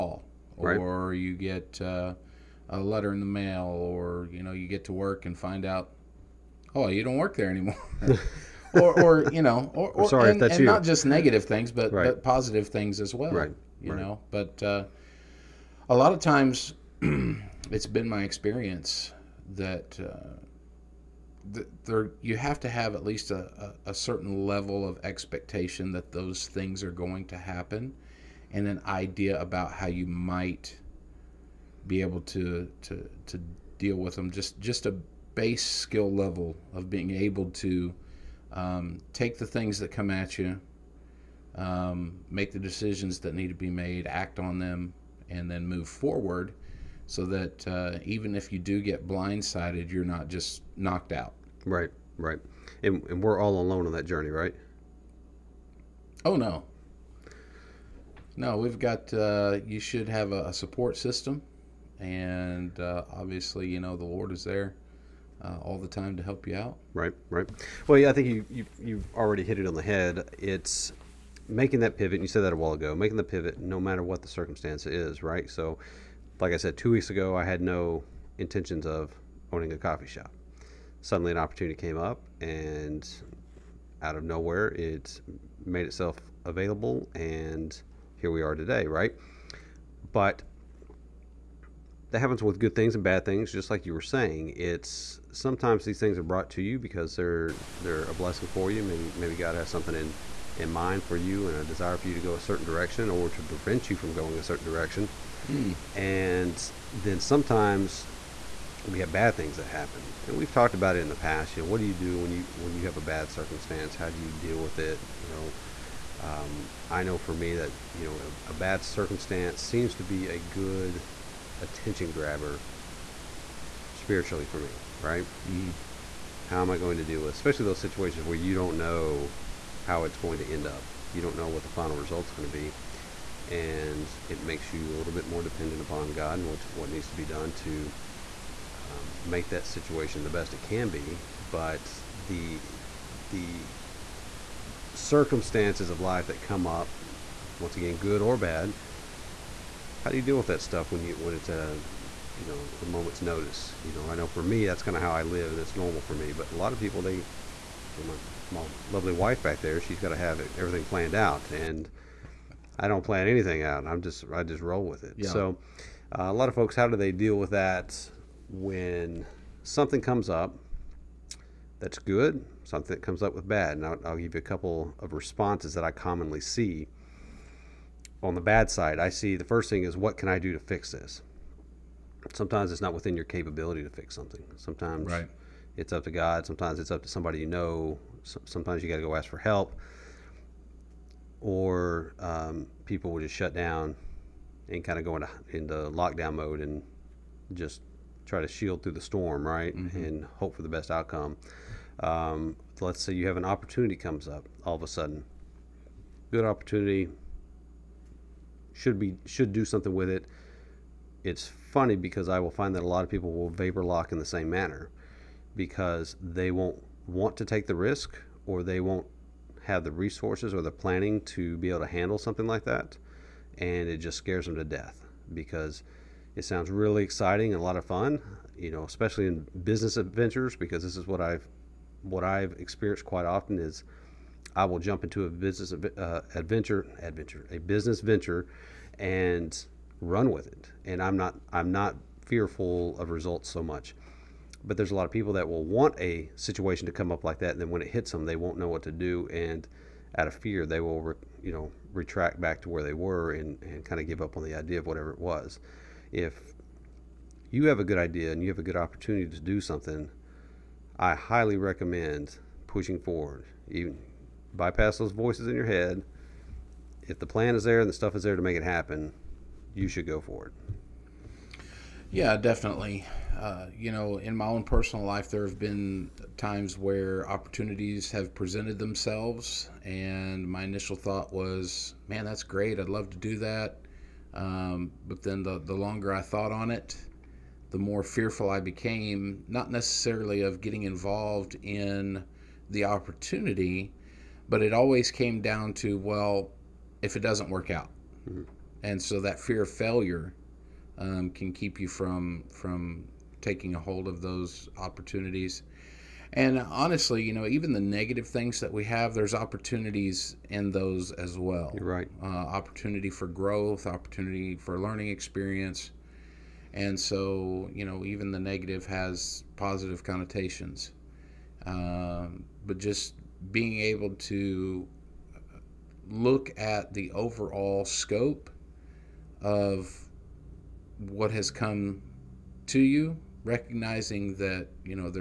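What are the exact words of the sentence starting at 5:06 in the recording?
And honestly, you know, even the negative things that we have, there's opportunities in those as well.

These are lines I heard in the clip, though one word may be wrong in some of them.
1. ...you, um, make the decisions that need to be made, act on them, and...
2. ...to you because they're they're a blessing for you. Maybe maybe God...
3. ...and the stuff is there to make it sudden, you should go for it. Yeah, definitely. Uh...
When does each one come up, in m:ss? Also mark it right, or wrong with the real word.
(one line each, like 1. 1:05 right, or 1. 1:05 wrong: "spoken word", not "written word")
1. 0:40 right
2. 1:36 right
3. 4:27 wrong: "happen", not "sudden".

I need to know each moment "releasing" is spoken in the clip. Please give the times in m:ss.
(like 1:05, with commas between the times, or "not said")
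not said.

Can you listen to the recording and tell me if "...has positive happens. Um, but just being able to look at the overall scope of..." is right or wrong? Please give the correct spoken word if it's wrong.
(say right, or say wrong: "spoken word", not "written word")
wrong: "connotations", not "happens".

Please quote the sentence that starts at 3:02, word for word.
Sometimes it's not within your capability to fix something.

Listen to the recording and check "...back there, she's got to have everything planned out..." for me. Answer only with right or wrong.
right.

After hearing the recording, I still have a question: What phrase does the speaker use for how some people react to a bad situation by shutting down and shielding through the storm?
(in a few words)
lockdown mode.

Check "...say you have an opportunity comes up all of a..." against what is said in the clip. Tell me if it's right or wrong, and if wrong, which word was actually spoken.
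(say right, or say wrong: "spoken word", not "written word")
right.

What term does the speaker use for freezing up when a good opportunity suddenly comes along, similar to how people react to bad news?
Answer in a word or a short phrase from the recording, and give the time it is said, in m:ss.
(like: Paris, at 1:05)
vapor lock, at 3:33.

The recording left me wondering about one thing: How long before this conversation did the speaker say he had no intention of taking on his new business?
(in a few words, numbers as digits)
2 weeks.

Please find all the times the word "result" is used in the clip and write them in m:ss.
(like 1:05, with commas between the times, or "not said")
2:11, 4:03.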